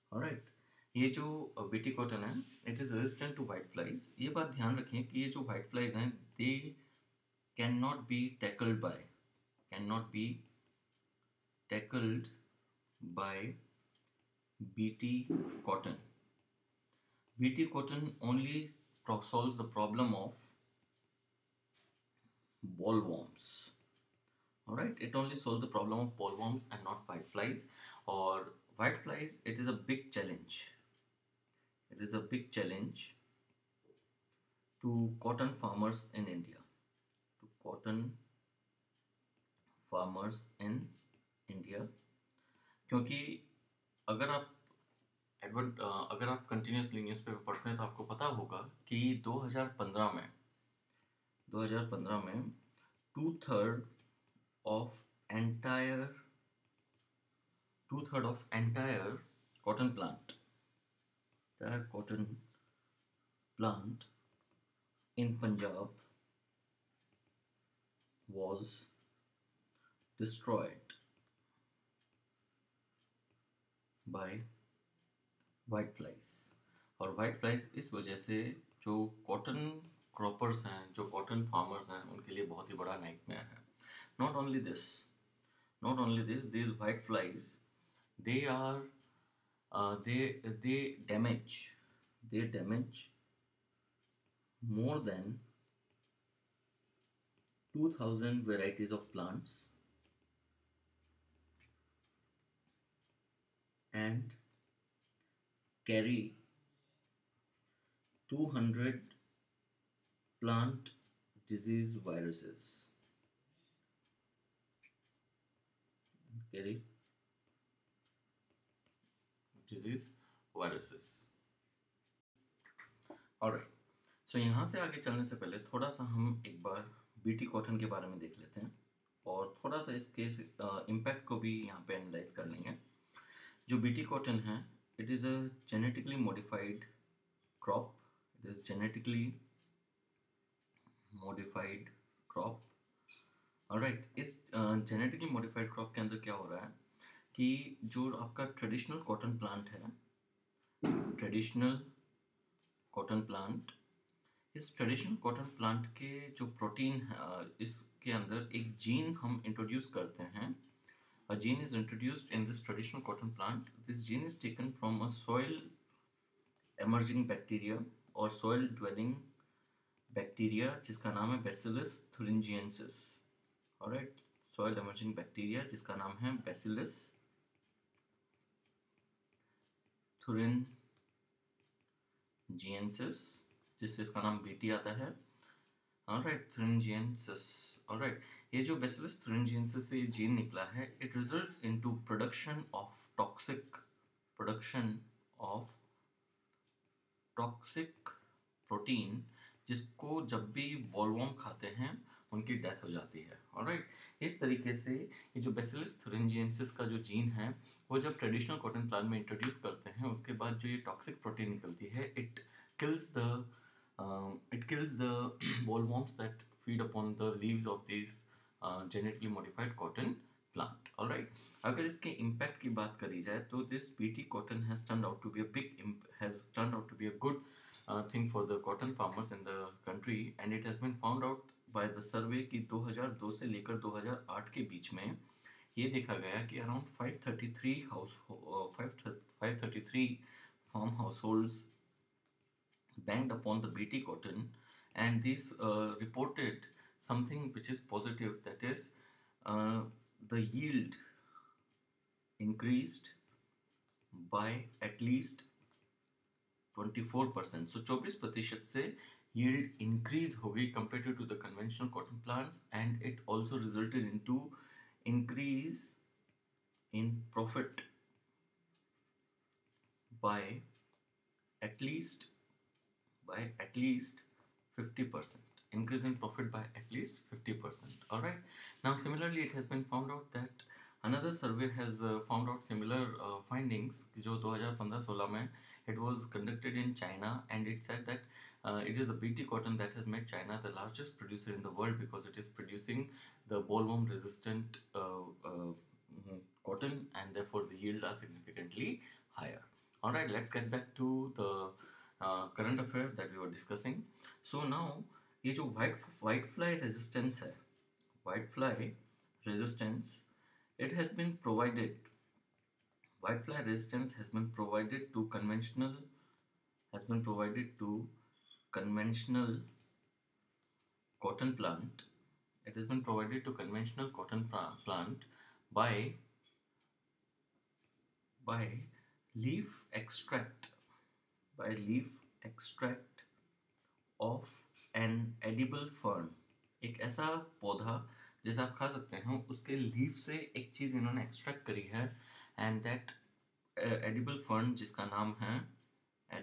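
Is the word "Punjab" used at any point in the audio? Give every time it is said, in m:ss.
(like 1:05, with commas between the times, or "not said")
1:05.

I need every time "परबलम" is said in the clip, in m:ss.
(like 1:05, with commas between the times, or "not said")
0:19, 0:25.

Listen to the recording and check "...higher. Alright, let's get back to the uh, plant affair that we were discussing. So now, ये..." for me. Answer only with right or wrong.
wrong.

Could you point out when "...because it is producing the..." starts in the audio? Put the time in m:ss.
4:51.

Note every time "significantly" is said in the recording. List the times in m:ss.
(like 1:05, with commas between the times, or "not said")
4:58.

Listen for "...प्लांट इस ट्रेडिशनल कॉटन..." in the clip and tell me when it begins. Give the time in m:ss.
2:33.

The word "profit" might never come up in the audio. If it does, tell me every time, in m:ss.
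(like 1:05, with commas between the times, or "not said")
4:27, 4:36.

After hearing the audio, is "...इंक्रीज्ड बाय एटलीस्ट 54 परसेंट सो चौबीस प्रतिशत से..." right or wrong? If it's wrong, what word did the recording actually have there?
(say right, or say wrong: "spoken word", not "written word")
wrong: "24", not "54".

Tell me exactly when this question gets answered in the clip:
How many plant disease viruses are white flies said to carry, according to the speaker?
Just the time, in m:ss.
1:48.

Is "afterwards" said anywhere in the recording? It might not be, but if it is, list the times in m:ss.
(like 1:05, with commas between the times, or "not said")
not said.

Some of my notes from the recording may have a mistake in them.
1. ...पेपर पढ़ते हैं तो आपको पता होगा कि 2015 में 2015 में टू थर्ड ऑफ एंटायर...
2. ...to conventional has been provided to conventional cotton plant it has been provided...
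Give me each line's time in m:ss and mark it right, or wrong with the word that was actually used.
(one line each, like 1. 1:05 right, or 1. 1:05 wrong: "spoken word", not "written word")
1. 0:47 right
2. 5:15 right.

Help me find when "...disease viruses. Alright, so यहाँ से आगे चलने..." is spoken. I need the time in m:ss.
1:59.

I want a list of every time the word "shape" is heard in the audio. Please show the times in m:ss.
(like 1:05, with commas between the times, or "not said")
not said.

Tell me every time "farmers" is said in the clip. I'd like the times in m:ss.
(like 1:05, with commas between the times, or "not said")
0:35, 0:39, 3:48.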